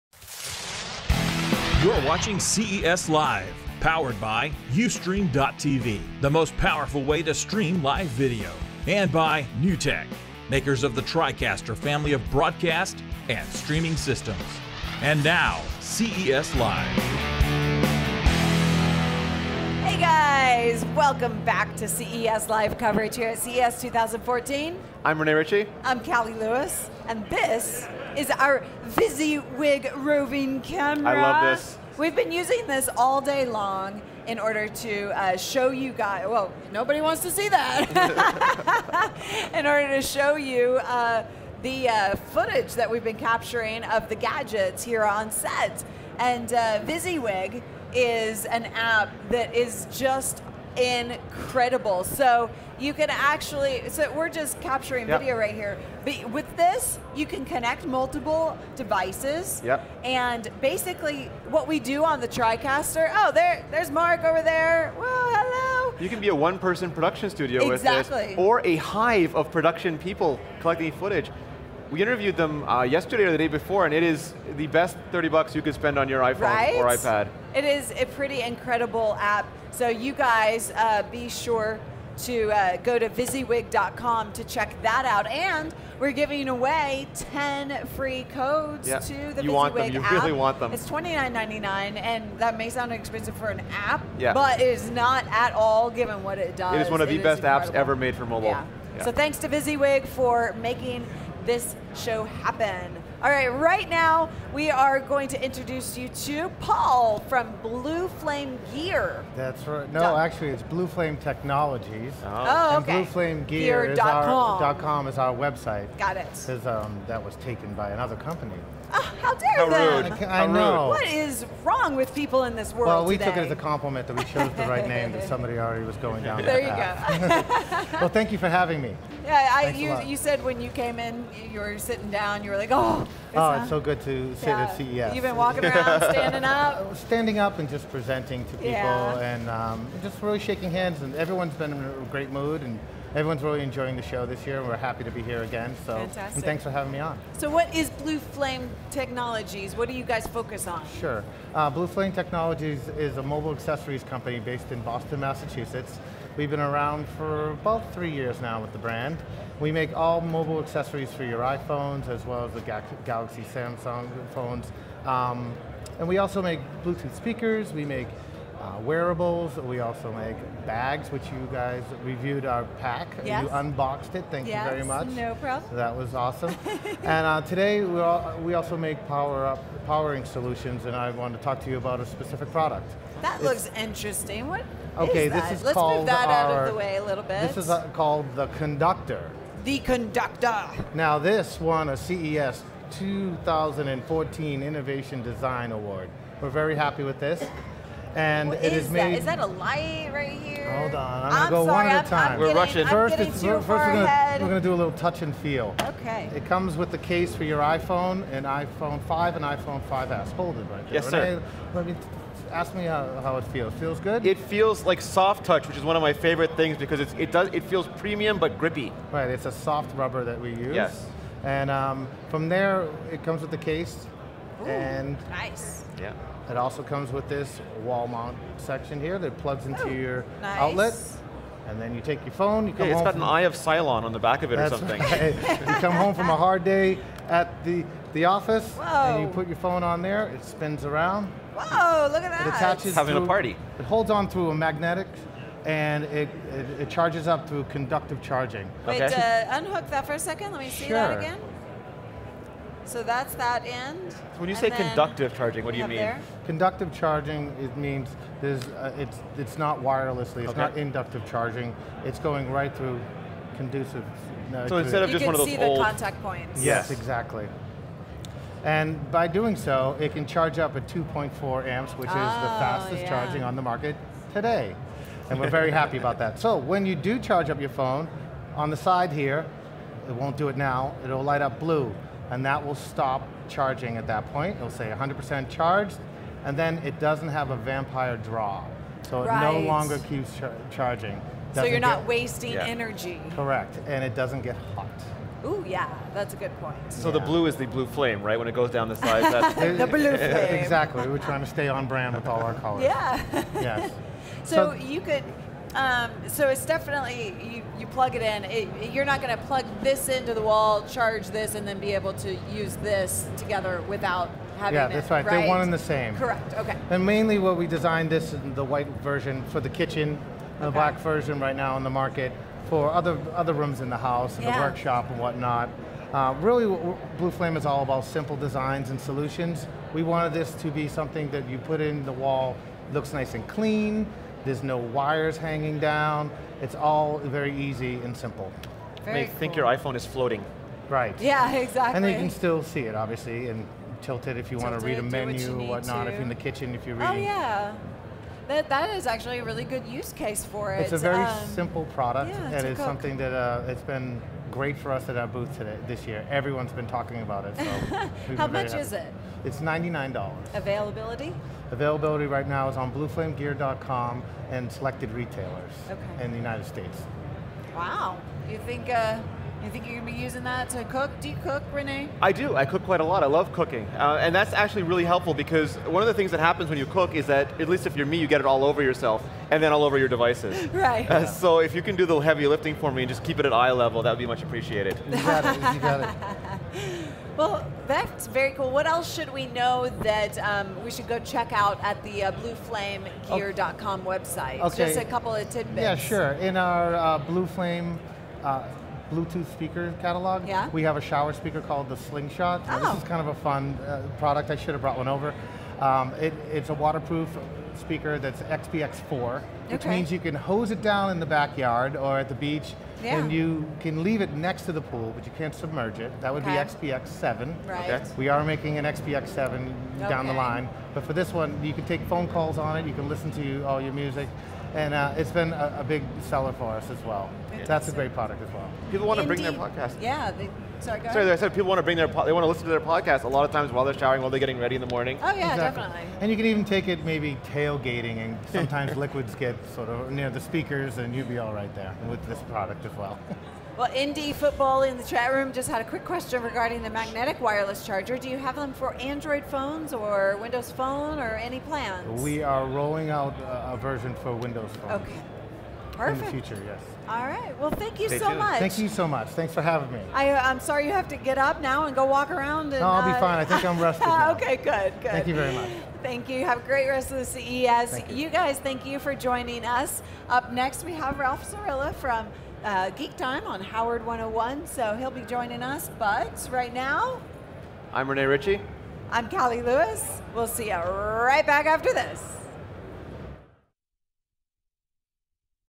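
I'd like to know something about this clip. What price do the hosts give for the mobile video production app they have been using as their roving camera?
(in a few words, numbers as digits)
$29.99.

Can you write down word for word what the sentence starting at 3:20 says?
Hold on, I'm, I'm gonna go sorry, one at a time.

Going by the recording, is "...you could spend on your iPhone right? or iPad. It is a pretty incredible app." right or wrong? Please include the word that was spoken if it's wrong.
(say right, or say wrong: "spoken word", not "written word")
right.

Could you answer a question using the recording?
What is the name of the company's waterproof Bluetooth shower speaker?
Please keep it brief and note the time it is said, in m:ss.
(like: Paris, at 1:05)
Slingshot, at 6:41.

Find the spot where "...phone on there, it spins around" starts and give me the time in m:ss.
3:59.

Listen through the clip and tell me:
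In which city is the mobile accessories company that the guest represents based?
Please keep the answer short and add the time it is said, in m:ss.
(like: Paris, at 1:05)
Boston, at 2:34.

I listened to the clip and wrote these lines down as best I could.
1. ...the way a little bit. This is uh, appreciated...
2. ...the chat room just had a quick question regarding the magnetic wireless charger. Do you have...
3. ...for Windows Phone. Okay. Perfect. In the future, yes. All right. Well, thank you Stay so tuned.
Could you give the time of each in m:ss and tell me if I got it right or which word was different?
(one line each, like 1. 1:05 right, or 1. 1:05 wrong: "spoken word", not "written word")
1. 3:06 wrong: "called", not "appreciated"
2. 7:24 right
3. 7:34 right.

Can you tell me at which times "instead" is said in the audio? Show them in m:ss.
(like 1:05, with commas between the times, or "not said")
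4:24.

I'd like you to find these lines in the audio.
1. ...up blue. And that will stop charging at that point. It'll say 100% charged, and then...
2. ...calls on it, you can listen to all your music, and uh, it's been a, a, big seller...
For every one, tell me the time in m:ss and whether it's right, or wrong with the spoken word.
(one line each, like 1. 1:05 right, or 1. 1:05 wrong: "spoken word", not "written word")
1. 4:41 right
2. 7:02 right.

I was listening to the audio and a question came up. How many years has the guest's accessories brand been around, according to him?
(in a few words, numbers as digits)
3.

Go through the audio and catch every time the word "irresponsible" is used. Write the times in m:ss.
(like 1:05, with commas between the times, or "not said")
not said.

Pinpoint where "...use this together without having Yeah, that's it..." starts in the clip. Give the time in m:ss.
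5:12.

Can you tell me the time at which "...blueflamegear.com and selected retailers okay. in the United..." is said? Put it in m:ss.
6:02.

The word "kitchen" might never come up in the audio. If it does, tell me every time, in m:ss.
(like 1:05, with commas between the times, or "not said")
5:19, 5:46.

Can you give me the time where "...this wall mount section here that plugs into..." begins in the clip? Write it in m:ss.
3:47.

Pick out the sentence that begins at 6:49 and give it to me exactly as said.
means you can hose it down in the backyard or at the beach, yeah.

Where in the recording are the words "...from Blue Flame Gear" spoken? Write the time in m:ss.
1:47.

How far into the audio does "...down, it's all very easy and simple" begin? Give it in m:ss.
5:35.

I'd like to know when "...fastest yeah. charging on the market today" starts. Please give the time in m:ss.
4:32.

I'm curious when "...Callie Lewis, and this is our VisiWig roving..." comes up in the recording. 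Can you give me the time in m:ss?
0:26.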